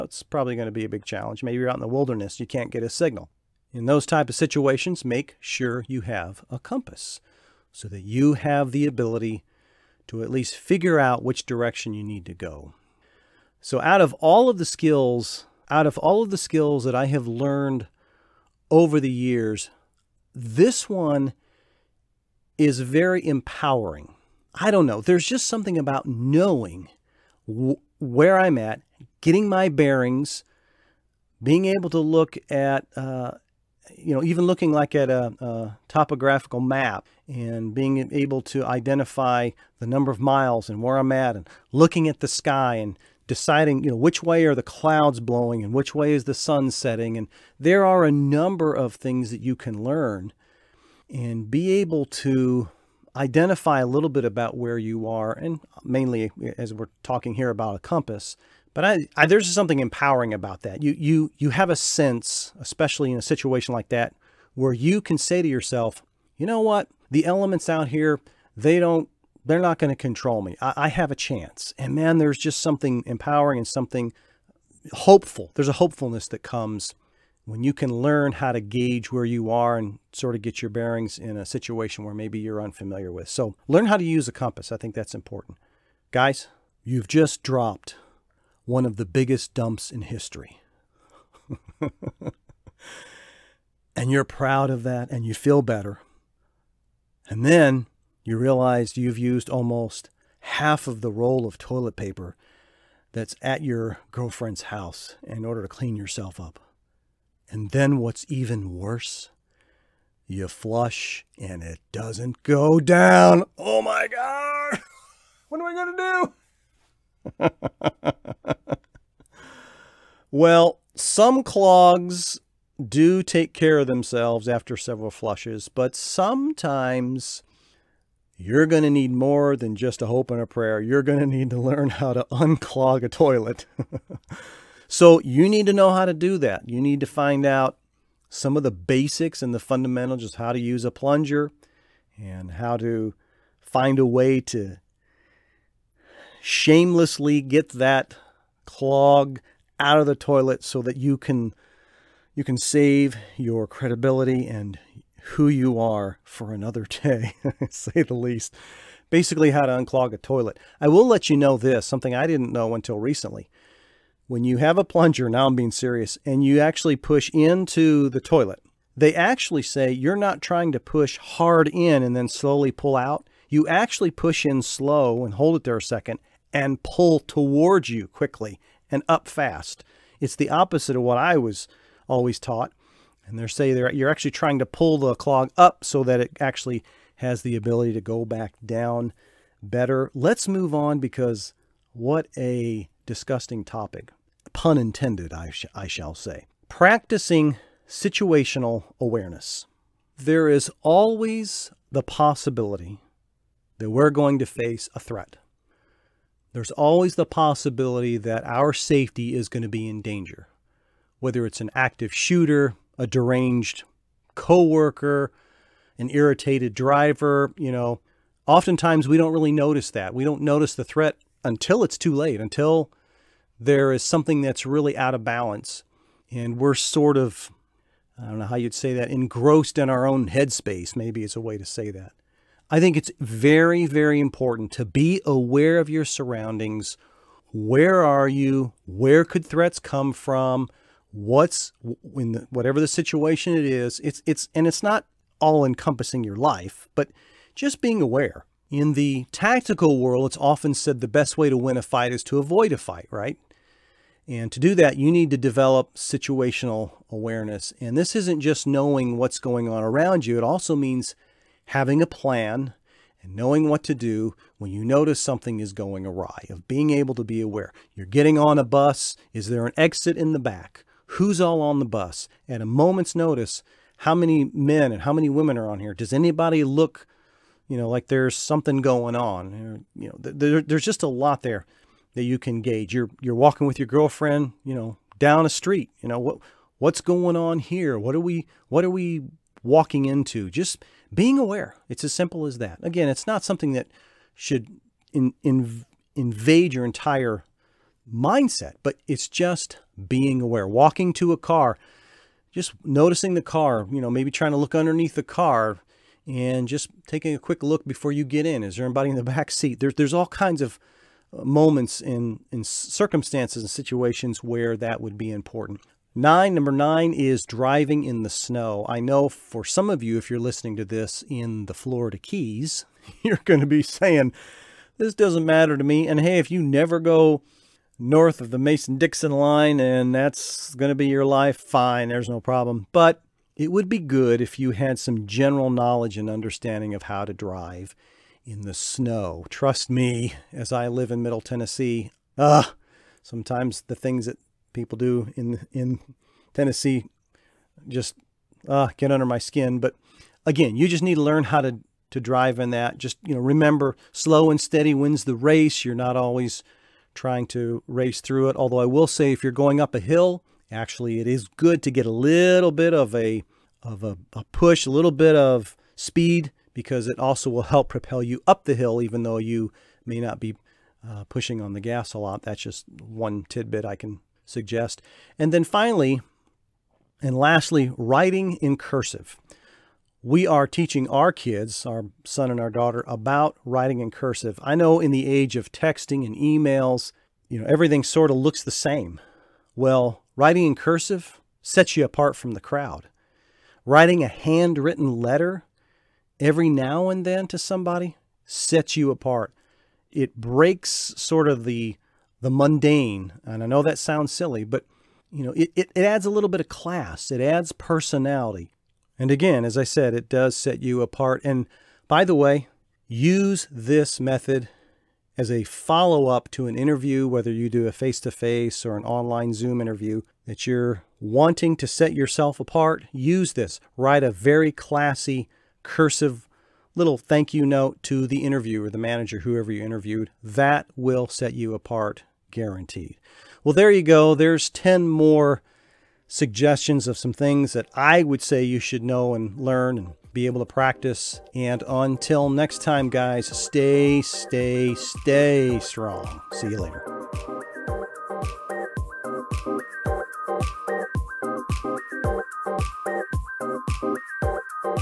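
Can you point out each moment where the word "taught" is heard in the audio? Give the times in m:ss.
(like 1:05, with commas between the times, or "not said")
3:02.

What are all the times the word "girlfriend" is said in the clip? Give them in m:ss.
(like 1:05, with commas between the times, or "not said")
1:44, 4:43.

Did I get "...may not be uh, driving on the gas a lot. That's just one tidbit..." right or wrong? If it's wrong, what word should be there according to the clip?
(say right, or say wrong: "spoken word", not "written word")
wrong: "pushing", not "driving".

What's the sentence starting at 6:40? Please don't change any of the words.
It breaks sort of the the mundane.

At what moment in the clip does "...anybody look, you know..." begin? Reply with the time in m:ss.
4:36.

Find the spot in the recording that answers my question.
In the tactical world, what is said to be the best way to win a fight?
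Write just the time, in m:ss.
4:12.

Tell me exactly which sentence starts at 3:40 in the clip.
We don't notice the threat until it's too late, until there is something that's really out of balance.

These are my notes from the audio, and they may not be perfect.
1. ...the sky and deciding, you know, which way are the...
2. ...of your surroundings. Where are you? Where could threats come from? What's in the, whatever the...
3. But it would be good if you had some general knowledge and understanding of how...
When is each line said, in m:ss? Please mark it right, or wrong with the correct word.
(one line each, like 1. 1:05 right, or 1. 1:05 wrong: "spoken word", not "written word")
1. 0:42 right
2. 3:55 right
3. 5:32 right.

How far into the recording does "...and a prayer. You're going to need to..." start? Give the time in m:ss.
2:10.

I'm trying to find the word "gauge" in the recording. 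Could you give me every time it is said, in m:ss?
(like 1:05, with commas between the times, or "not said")
1:18, 4:42.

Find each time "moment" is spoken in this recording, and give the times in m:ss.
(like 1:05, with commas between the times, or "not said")
4:32, 5:11.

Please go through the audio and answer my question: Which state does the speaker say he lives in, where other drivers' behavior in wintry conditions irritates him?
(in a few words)
Middle Tennessee.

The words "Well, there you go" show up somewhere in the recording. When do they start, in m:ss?
7:13.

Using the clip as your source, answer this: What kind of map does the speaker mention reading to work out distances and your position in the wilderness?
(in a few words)
topographical map.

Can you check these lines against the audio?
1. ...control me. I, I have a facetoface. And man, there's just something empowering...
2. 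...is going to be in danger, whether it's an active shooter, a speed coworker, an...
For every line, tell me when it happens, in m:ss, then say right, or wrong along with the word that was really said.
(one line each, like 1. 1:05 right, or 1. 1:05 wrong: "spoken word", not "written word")
1. 1:09 wrong: "chance", not "facetoface"
2. 3:29 wrong: "deranged", not "speed".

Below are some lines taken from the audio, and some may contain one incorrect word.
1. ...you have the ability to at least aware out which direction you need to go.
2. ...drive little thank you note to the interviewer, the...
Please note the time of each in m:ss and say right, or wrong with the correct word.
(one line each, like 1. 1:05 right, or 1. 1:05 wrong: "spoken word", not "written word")
1. 0:08 wrong: "figure", not "aware"
2. 7:05 wrong: "cursive", not "drive".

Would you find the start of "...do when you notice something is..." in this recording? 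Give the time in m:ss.
4:23.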